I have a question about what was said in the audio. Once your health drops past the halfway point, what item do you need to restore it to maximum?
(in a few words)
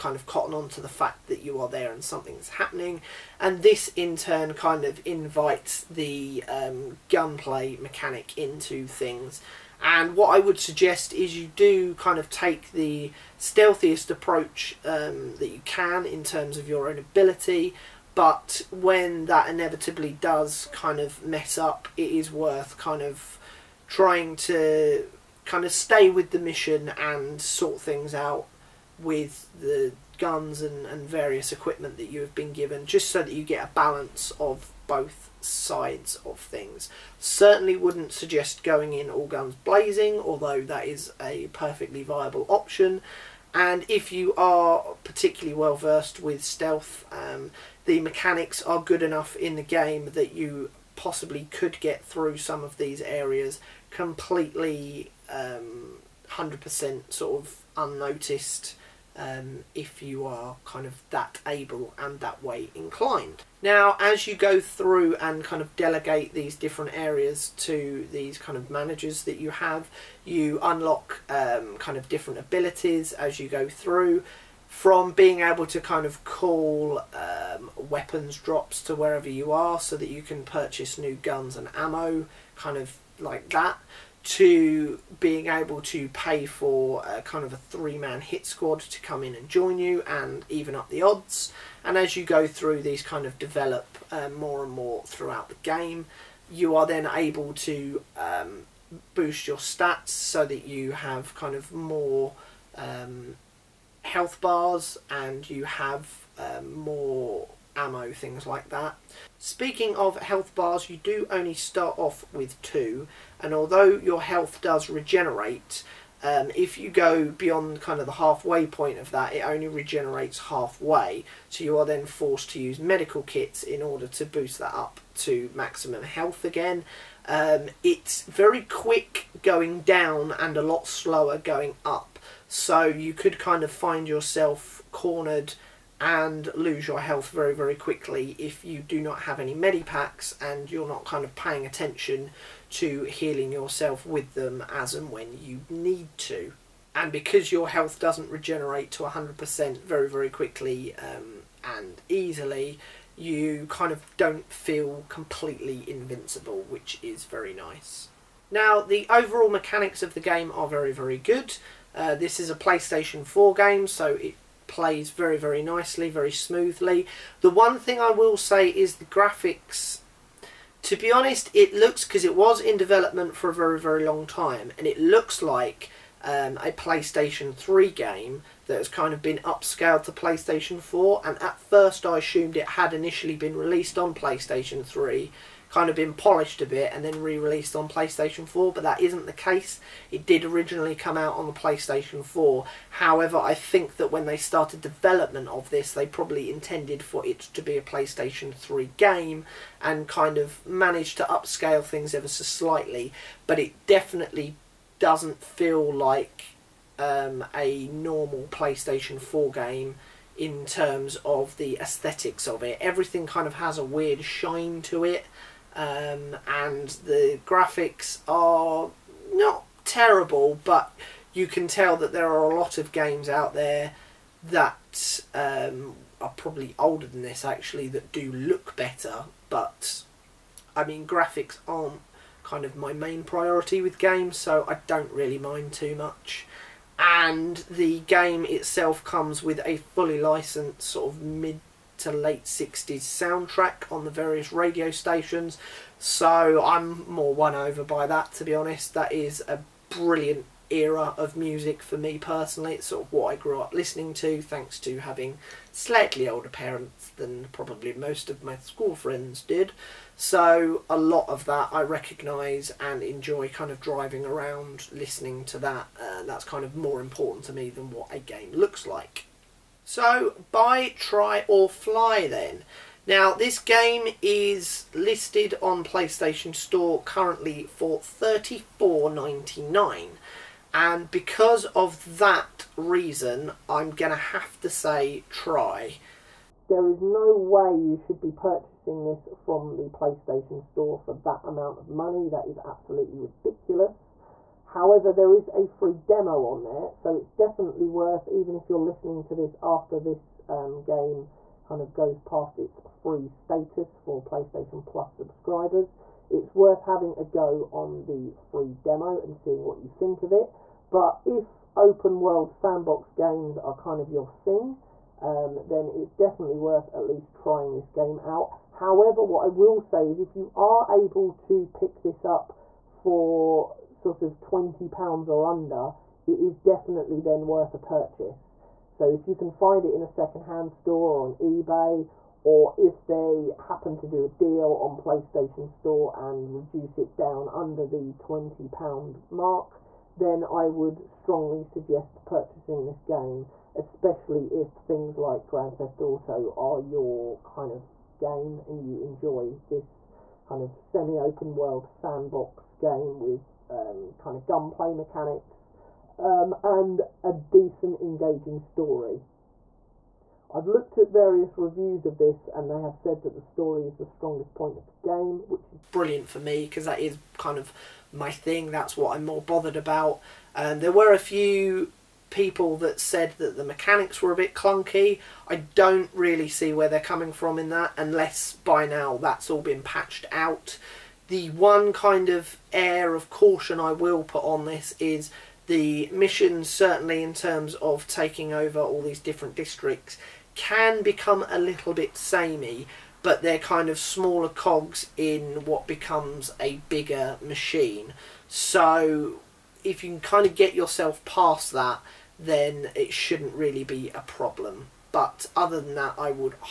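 medical kits.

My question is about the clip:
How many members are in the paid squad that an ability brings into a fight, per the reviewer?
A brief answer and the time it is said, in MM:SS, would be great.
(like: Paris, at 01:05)
3, at 01:27.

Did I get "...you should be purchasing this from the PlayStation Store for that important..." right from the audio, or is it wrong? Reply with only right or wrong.
wrong.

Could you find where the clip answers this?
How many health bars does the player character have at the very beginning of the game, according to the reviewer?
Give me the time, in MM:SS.
01:52.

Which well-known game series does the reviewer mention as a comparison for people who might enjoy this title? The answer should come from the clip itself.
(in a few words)
Grand Theft Auto.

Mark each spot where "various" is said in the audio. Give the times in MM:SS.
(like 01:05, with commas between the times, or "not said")
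00:31, 04:04, 06:01.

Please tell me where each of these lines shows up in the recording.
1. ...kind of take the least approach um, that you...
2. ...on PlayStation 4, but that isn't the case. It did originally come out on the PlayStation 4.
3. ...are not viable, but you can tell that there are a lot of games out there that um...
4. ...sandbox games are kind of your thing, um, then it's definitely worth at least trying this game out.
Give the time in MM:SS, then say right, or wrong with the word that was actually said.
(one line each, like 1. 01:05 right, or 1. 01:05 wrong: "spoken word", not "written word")
1. 00:11 wrong: "stealthiest", not "least"
2. 03:07 right
3. 03:38 wrong: "terrible", not "viable"
4. 05:12 right.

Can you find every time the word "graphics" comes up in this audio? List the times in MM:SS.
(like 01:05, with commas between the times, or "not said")
02:49, 03:37, 03:51.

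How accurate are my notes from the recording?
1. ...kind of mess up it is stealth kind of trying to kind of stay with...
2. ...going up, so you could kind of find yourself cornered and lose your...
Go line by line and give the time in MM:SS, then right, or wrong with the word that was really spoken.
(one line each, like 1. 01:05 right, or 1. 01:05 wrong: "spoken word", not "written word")
1. 00:20 wrong: "worth", not "stealth"
2. 02:11 right.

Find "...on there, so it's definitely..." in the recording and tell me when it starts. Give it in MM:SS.
04:56.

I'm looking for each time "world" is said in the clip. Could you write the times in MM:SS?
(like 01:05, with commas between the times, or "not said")
05:12, 05:51.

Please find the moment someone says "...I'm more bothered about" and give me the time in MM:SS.
06:09.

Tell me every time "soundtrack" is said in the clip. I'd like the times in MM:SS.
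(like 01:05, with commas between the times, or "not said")
04:02.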